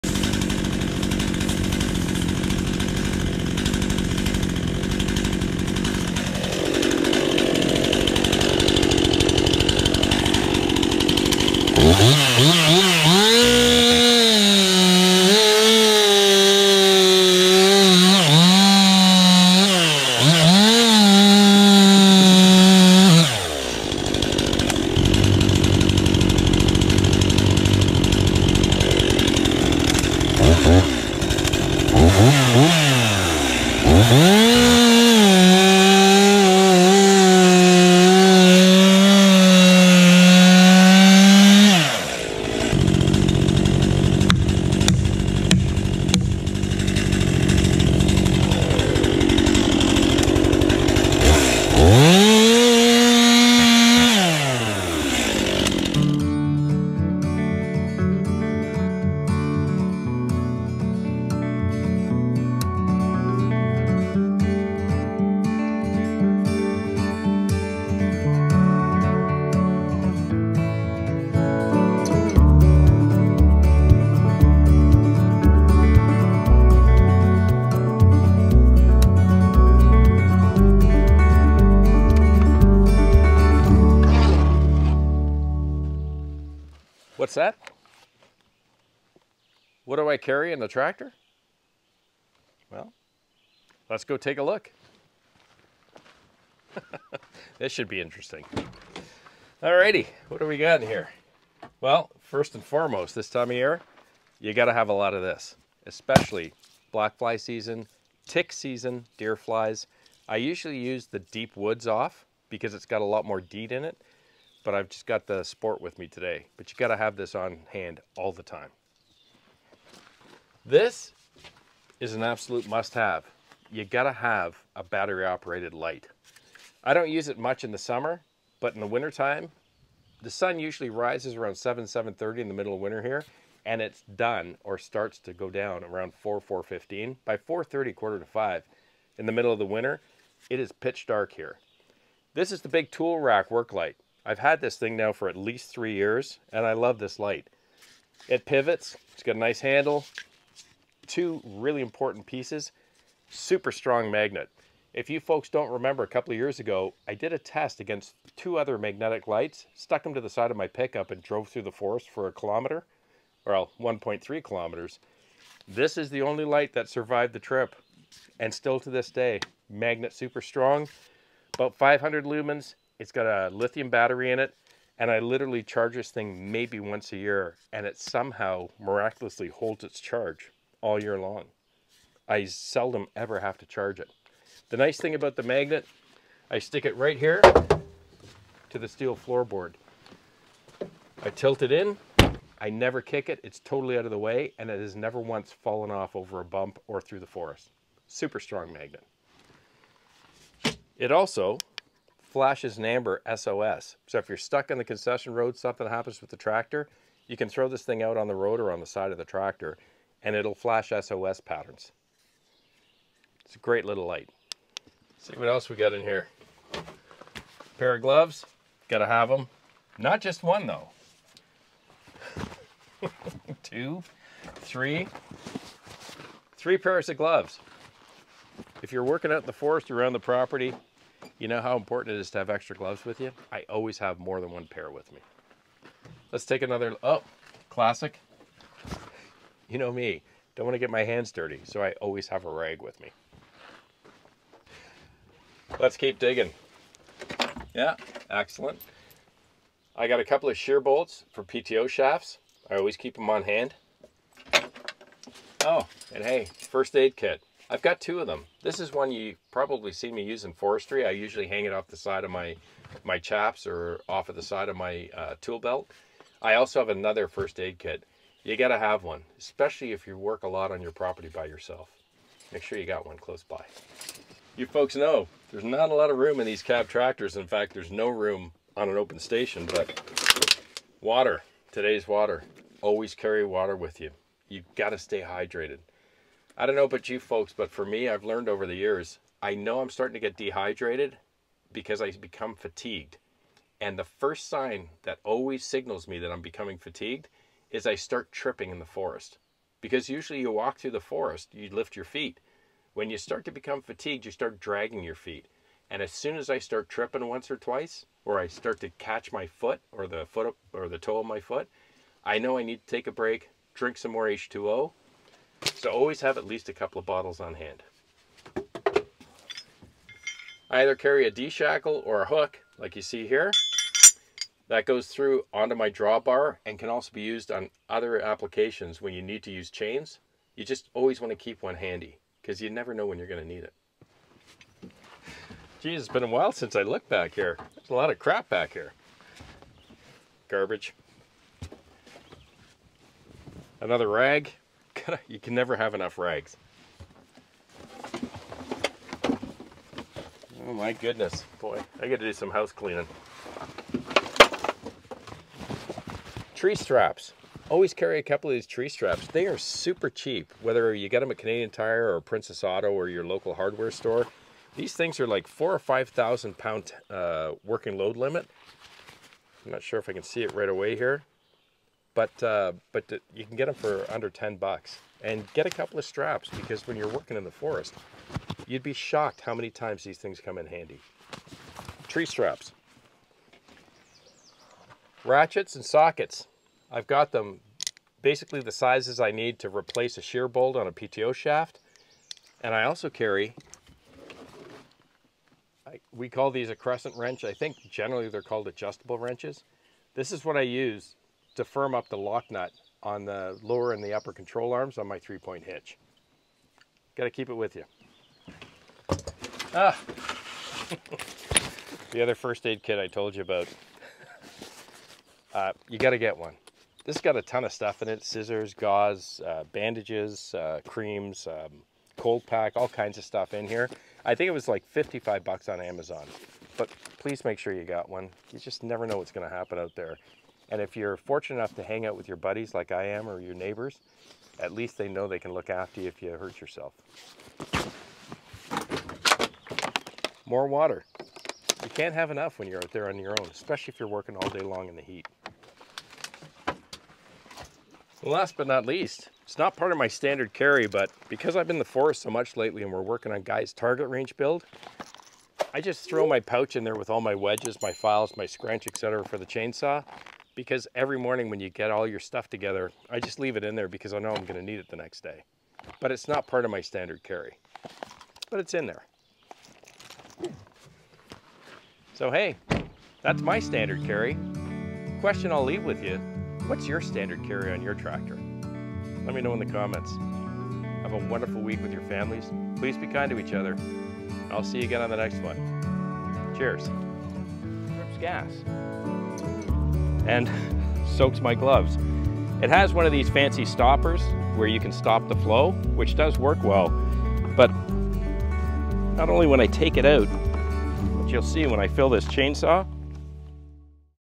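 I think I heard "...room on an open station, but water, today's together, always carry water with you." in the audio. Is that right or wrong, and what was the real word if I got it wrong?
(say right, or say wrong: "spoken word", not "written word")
wrong: "water", not "together".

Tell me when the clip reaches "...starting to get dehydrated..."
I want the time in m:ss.
4:49.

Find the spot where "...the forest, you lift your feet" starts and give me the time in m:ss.
5:00.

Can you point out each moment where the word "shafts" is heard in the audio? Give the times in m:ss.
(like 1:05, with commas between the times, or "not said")
4:11, 6:31.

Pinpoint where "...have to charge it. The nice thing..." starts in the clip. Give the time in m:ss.
3:03.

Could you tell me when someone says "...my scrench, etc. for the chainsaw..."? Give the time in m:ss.
7:38.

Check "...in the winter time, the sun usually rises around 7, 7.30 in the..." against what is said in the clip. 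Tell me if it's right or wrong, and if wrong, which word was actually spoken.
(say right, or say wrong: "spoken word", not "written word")
right.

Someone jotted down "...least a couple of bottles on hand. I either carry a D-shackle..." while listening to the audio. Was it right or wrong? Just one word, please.
right.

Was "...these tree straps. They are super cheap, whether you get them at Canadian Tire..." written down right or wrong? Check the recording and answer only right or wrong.
right.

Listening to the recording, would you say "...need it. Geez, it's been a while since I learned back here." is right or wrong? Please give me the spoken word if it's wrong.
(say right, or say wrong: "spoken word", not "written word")
wrong: "looked", not "learned".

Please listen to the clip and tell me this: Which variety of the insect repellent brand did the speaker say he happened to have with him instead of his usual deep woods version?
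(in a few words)
Sport.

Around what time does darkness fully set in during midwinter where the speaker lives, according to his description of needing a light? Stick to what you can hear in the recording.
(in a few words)
4:30 to 4:45.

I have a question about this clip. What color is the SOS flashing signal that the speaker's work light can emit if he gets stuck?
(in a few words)
Amber.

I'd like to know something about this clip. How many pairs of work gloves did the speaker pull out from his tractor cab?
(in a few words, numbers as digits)
3.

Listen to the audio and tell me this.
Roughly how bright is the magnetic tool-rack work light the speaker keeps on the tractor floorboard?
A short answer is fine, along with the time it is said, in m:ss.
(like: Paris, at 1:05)
About 500 lumens, at 2:51.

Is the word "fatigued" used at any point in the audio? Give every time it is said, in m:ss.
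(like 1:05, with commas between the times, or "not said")
4:52, 4:56, 5:03.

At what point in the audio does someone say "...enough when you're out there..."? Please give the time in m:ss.
7:22.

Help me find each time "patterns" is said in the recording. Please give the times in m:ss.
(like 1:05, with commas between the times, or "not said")
3:31.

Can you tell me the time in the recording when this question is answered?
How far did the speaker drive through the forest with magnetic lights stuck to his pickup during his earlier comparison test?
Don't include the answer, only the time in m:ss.
2:43.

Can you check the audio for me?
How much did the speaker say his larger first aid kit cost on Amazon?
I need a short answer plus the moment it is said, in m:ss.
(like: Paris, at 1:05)
$55, at 7:04.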